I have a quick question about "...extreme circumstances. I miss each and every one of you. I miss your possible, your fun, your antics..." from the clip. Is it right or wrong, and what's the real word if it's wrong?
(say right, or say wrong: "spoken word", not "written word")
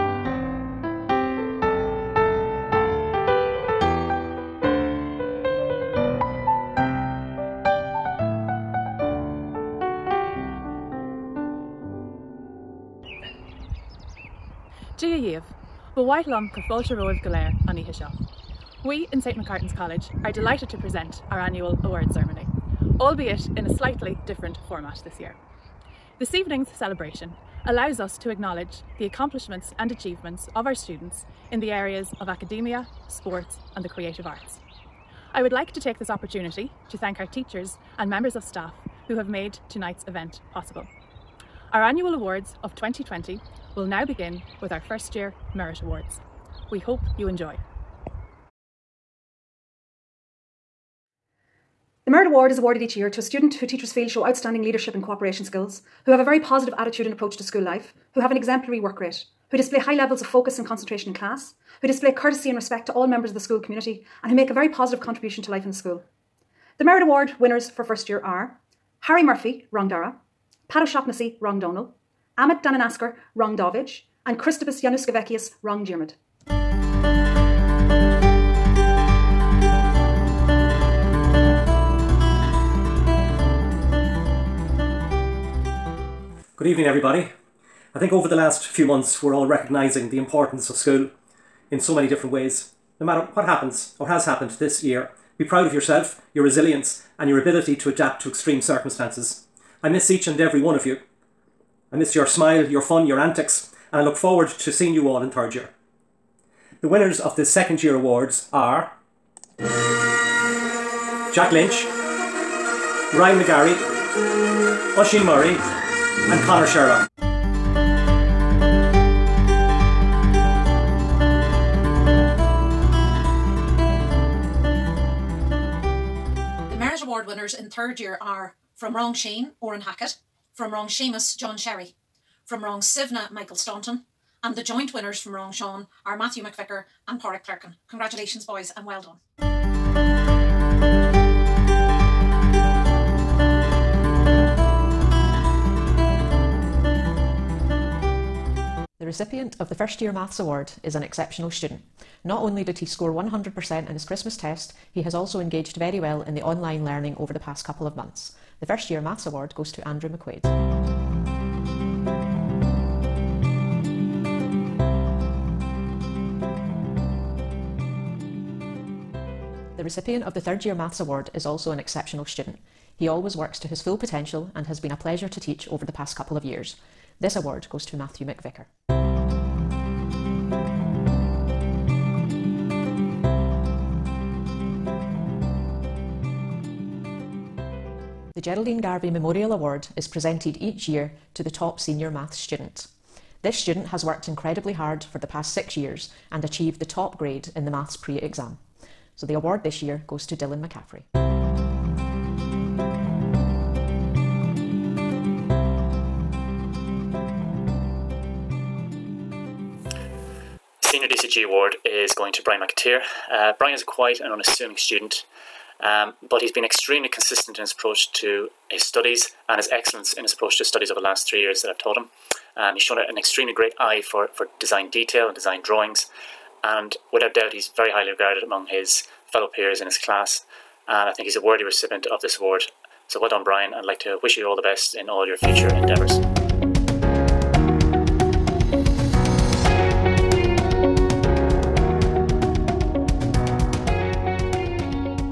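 wrong: "smile", not "possible".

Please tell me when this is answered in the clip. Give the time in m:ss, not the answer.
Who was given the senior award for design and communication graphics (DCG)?
3:32.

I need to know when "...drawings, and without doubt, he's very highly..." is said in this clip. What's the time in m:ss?
3:45.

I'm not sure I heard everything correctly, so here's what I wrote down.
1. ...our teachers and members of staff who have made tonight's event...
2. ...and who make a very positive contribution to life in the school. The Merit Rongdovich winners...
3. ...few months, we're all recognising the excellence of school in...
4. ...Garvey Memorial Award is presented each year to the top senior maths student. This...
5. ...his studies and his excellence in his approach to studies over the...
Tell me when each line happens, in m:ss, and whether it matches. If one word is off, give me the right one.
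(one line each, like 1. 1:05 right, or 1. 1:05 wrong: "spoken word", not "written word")
1. 0:37 right
2. 1:04 wrong: "Award", not "Rongdovich"
3. 1:28 wrong: "importance", not "excellence"
4. 3:08 right
5. 3:38 right.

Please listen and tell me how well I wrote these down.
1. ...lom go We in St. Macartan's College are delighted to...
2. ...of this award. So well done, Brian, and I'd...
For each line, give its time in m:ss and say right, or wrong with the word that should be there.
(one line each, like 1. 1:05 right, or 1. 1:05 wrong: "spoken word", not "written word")
1. 0:16 right
2. 3:52 right.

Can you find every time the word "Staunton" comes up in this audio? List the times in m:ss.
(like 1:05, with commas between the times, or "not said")
2:13.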